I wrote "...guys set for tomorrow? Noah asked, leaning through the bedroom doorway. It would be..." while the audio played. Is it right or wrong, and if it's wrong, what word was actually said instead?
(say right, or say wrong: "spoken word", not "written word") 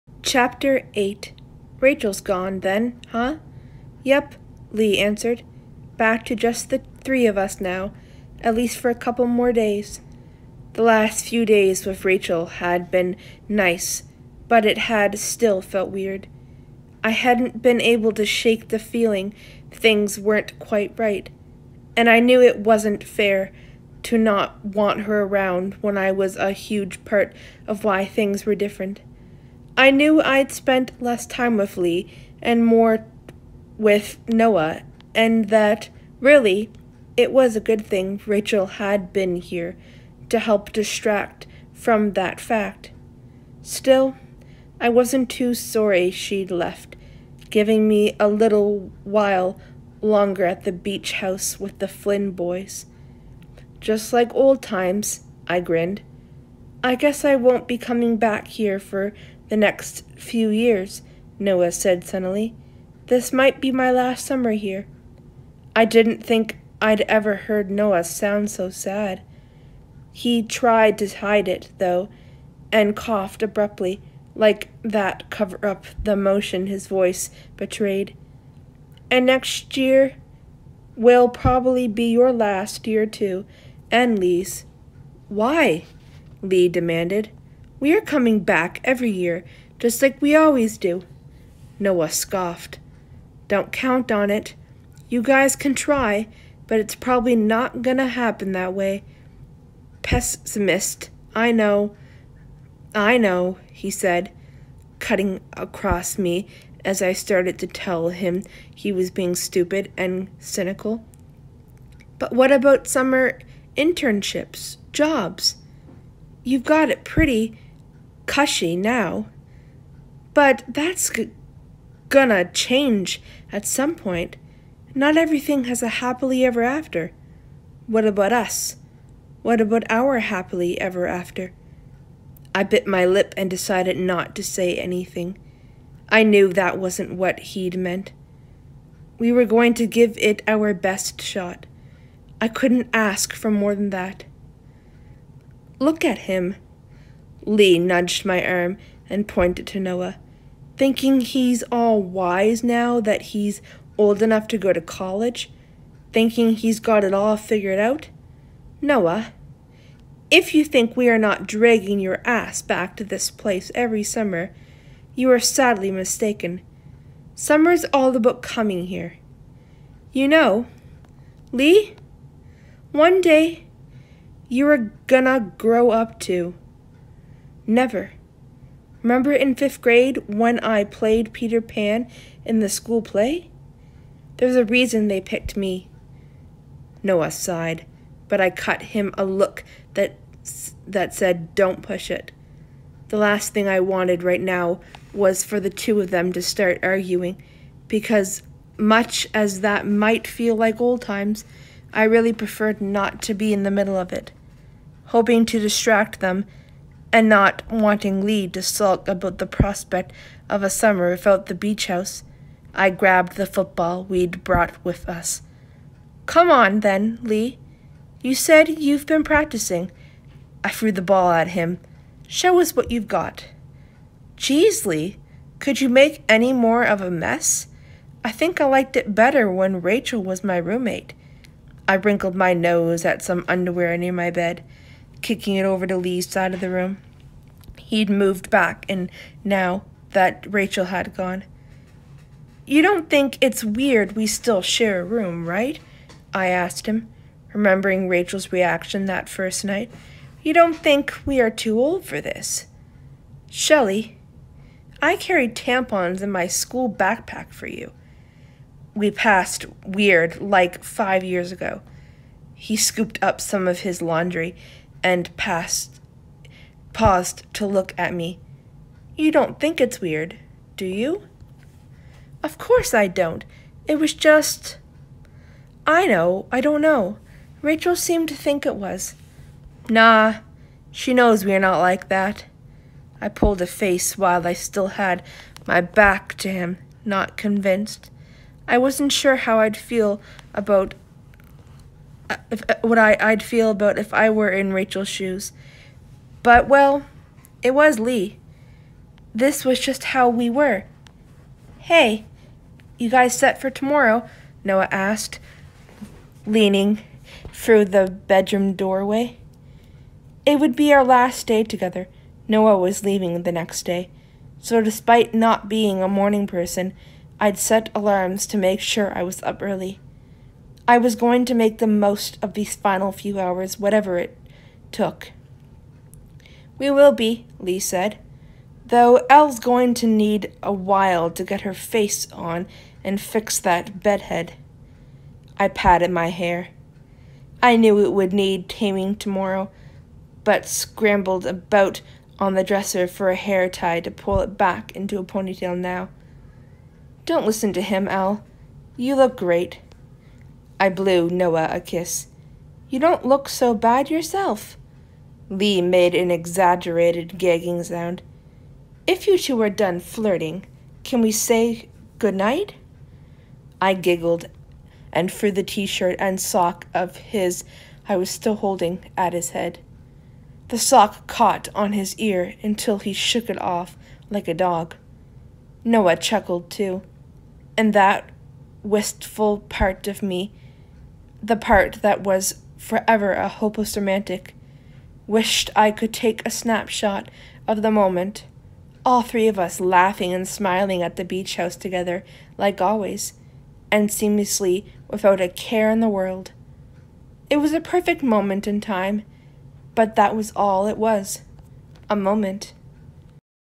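right.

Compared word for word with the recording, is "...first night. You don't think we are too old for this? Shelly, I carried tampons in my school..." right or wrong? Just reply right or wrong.
right.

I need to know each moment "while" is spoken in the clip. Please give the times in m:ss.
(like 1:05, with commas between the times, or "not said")
0:49, 4:44, 5:30.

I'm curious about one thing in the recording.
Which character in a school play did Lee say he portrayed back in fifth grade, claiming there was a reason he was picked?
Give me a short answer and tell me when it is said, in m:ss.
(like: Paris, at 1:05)
Peter Pan, at 3:01.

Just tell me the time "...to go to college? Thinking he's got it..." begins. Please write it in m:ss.
2:34.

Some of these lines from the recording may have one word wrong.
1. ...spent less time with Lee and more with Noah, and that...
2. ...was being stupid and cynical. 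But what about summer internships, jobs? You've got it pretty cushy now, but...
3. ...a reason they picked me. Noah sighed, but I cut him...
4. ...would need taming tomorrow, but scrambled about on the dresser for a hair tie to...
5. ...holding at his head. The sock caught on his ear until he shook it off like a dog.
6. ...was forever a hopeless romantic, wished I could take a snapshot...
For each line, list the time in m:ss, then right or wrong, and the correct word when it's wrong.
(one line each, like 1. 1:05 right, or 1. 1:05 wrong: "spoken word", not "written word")
1. 0:30 right
2. 1:48 right
3. 3:04 right
4. 5:38 right
5. 6:08 right
6. 6:22 right.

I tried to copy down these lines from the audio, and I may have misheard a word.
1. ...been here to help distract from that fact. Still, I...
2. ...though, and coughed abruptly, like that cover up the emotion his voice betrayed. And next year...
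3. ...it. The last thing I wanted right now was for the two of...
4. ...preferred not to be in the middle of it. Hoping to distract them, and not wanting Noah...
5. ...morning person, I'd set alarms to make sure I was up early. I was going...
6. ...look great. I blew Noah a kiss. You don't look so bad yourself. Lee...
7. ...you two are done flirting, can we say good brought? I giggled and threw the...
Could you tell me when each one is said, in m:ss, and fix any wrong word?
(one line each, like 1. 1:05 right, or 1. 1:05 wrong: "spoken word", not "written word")
1. 0:39 right
2. 1:11 right
3. 3:12 right
4. 3:22 wrong: "Lee", not "Noah"
5. 5:16 right
6. 5:49 right
7. 5:59 wrong: "night", not "brought".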